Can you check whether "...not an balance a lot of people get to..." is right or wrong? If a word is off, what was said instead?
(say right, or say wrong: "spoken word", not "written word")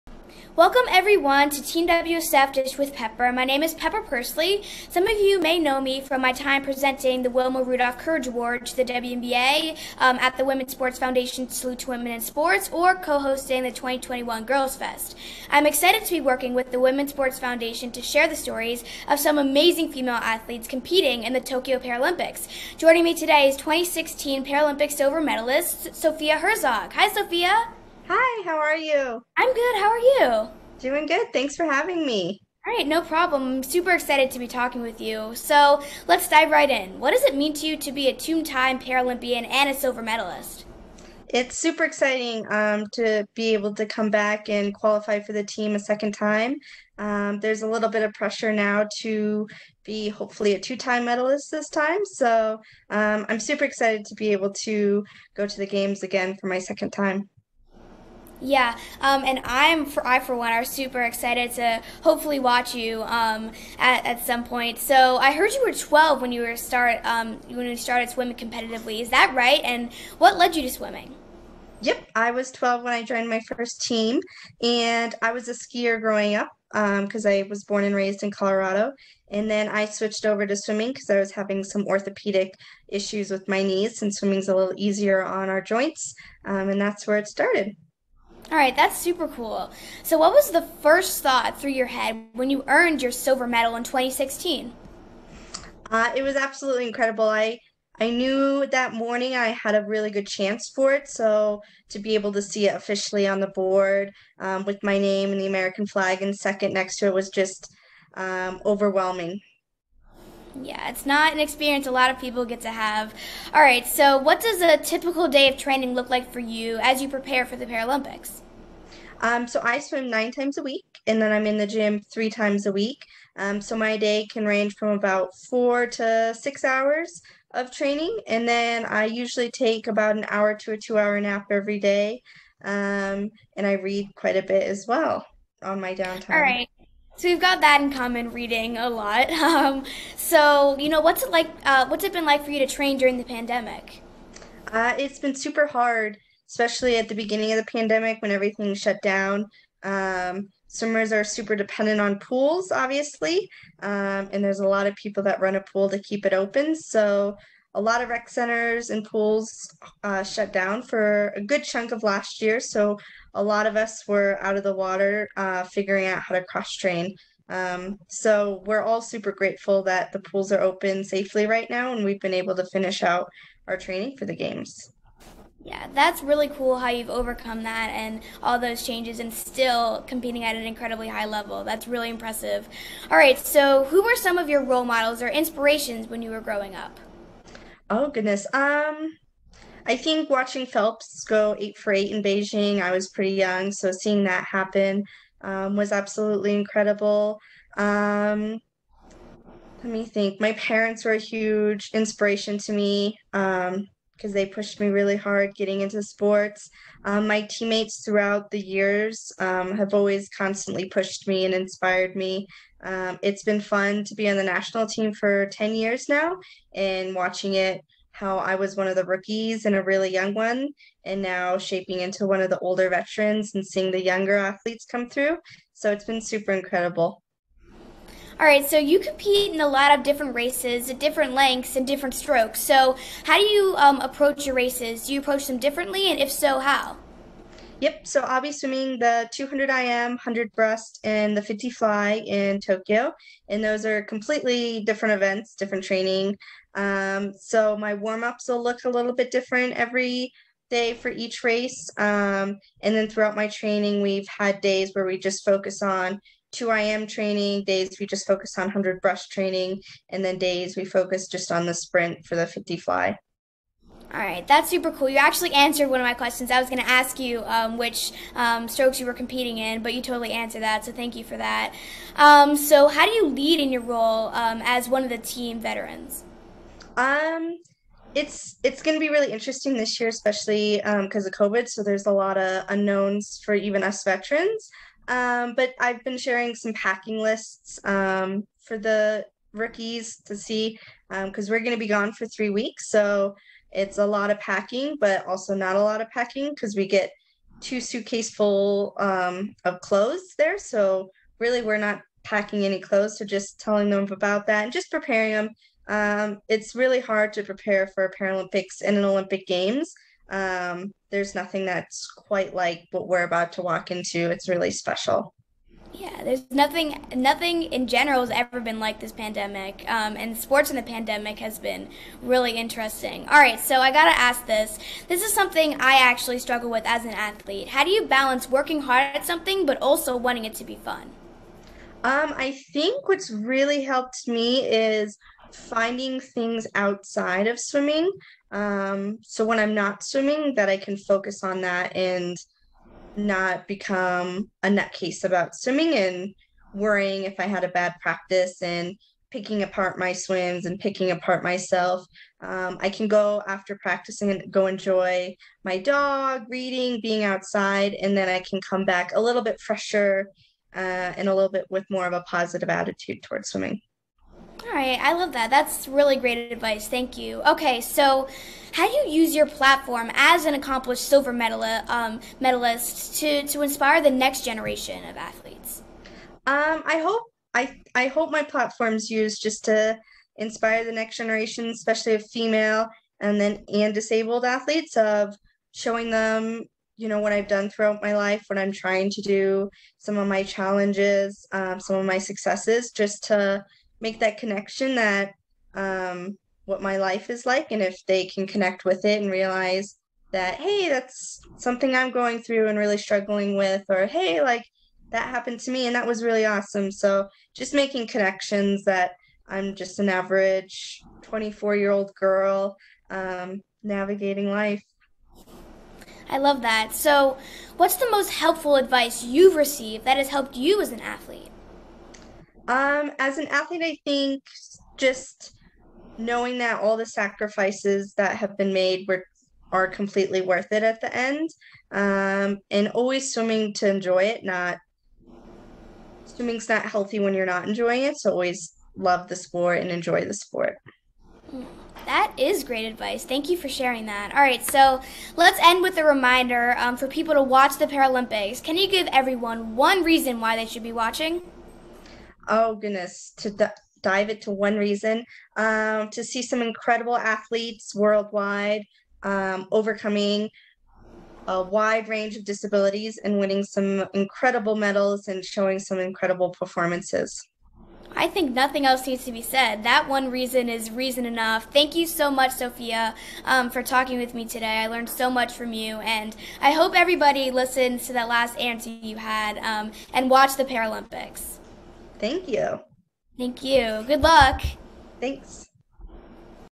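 wrong: "experience", not "balance".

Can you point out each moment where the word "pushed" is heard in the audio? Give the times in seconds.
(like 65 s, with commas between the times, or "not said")
204 s, 210 s.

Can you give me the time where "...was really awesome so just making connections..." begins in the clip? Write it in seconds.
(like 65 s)
406 s.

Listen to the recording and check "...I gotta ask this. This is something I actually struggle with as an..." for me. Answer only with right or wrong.
right.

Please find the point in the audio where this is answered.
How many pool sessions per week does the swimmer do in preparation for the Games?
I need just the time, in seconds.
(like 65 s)
120 s.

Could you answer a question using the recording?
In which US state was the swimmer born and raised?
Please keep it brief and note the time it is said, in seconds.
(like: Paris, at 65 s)
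Colorado, at 78 s.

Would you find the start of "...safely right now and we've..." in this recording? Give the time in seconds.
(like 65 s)
171 s.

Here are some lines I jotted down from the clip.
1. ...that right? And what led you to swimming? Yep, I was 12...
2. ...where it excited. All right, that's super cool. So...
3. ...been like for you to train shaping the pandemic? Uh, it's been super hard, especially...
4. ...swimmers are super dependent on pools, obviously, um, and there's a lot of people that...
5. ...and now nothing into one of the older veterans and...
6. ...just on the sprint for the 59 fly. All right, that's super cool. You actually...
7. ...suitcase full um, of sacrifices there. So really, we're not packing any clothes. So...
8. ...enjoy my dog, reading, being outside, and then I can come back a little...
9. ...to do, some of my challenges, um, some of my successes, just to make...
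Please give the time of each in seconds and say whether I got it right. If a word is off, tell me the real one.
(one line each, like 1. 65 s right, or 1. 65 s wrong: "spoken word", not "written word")
1. 69 s right
2. 87 s wrong: "started", not "excited"
3. 142 s wrong: "during", not "shaping"
4. 150 s right
5. 221 s wrong: "shaping", not "nothing"
6. 261 s wrong: "50", not "59"
7. 297 s wrong: "clothes", not "sacrifices"
8. 354 s right
9. 389 s right.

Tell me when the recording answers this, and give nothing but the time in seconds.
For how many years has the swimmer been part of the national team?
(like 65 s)
215 s.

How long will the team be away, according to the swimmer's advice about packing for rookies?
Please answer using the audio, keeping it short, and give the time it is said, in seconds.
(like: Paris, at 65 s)
3 weeks, at 292 s.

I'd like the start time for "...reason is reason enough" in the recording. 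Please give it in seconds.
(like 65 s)
470 s.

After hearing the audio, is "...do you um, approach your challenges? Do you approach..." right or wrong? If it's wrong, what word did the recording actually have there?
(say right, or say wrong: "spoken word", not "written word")
wrong: "races", not "challenges".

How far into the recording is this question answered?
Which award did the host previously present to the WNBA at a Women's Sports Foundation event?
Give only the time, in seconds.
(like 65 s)
7 s.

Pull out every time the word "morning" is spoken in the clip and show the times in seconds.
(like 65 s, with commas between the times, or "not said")
98 s.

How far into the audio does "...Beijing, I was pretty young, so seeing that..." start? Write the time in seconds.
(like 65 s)
192 s.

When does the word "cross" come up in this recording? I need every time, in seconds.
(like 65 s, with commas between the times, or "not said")
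166 s.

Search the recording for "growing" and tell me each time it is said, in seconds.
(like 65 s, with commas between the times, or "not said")
76 s, 186 s.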